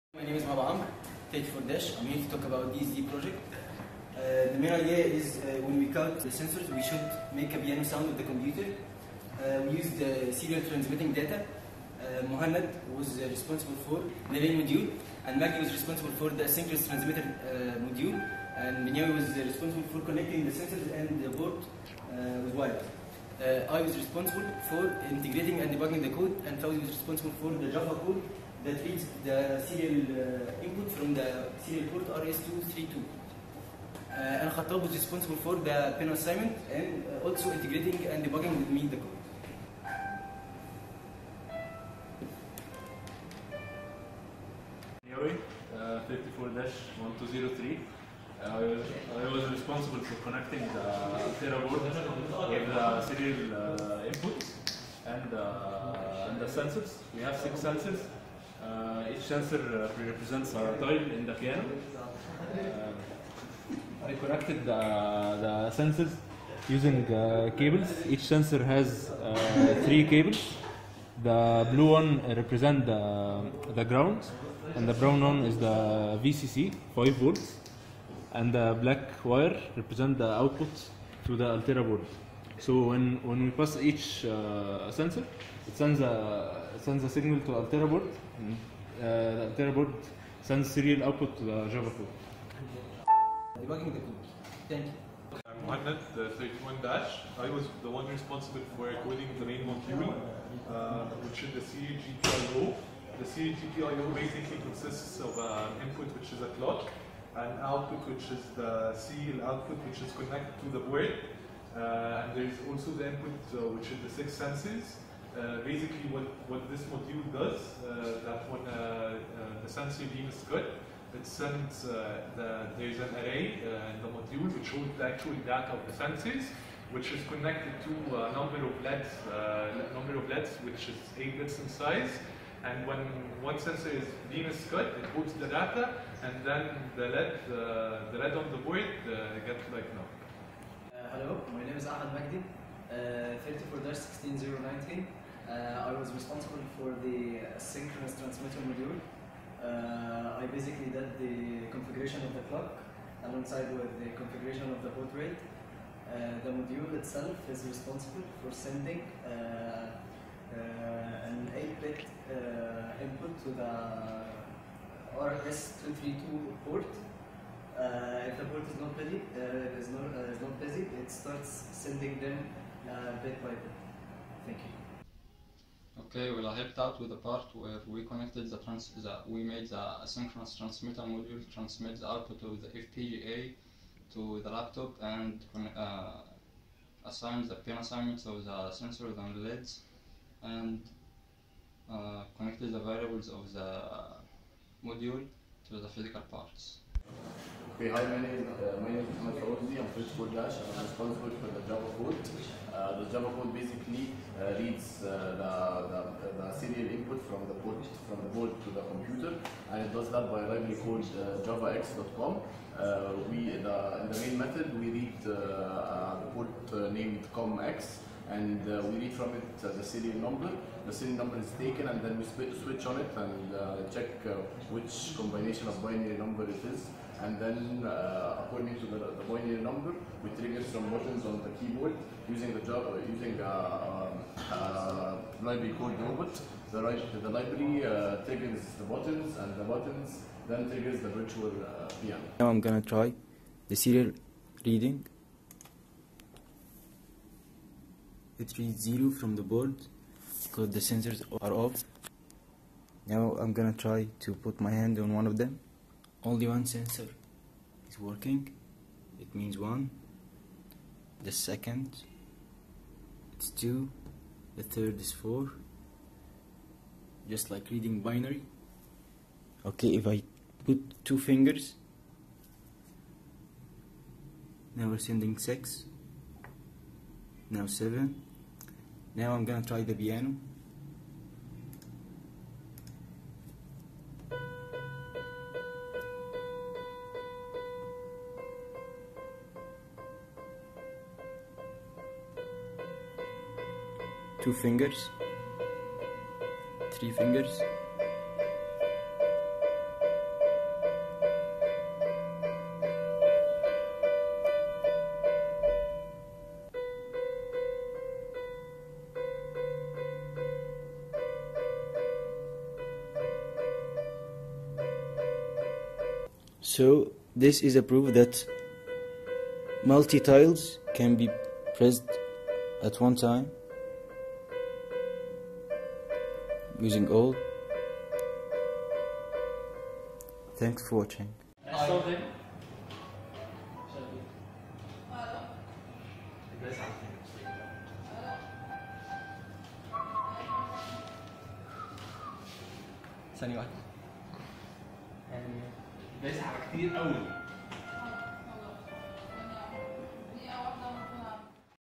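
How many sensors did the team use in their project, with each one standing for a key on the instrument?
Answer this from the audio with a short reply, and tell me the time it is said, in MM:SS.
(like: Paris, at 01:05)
6, at 00:57.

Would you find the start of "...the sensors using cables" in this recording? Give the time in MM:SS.
01:05.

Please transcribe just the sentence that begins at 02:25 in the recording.
Uh, I was responsible for the synchronous transmitter module.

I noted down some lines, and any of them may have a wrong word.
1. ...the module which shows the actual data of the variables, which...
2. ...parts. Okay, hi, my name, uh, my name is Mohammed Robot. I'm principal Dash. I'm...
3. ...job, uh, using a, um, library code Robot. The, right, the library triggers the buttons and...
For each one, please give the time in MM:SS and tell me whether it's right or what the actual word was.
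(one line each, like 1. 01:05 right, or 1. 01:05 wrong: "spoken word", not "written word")
1. 02:04 wrong: "senses", not "variables"
2. 03:16 wrong: "Fawzi", not "Robot"
3. 03:52 right.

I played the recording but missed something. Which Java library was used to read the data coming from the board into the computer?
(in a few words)
javax.comm.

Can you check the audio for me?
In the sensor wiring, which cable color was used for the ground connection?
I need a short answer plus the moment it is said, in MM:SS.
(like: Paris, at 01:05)
Blue, at 01:11.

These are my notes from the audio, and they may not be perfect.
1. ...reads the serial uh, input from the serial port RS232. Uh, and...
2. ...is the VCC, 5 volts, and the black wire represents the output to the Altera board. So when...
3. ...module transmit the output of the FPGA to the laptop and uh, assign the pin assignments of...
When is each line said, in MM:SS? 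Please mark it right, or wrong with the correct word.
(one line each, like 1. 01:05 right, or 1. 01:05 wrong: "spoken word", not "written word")
1. 00:28 right
2. 01:15 right
3. 03:01 right.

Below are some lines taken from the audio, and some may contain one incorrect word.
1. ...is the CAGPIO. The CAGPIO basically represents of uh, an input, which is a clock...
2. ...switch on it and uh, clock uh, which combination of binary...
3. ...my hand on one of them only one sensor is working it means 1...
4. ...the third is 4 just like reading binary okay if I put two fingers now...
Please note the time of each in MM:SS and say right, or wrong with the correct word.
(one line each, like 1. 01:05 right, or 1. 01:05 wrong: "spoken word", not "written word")
1. 01:41 wrong: "consists", not "represents"
2. 03:42 wrong: "check", not "clock"
3. 04:14 right
4. 04:24 right.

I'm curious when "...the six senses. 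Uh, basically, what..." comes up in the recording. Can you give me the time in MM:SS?
01:54.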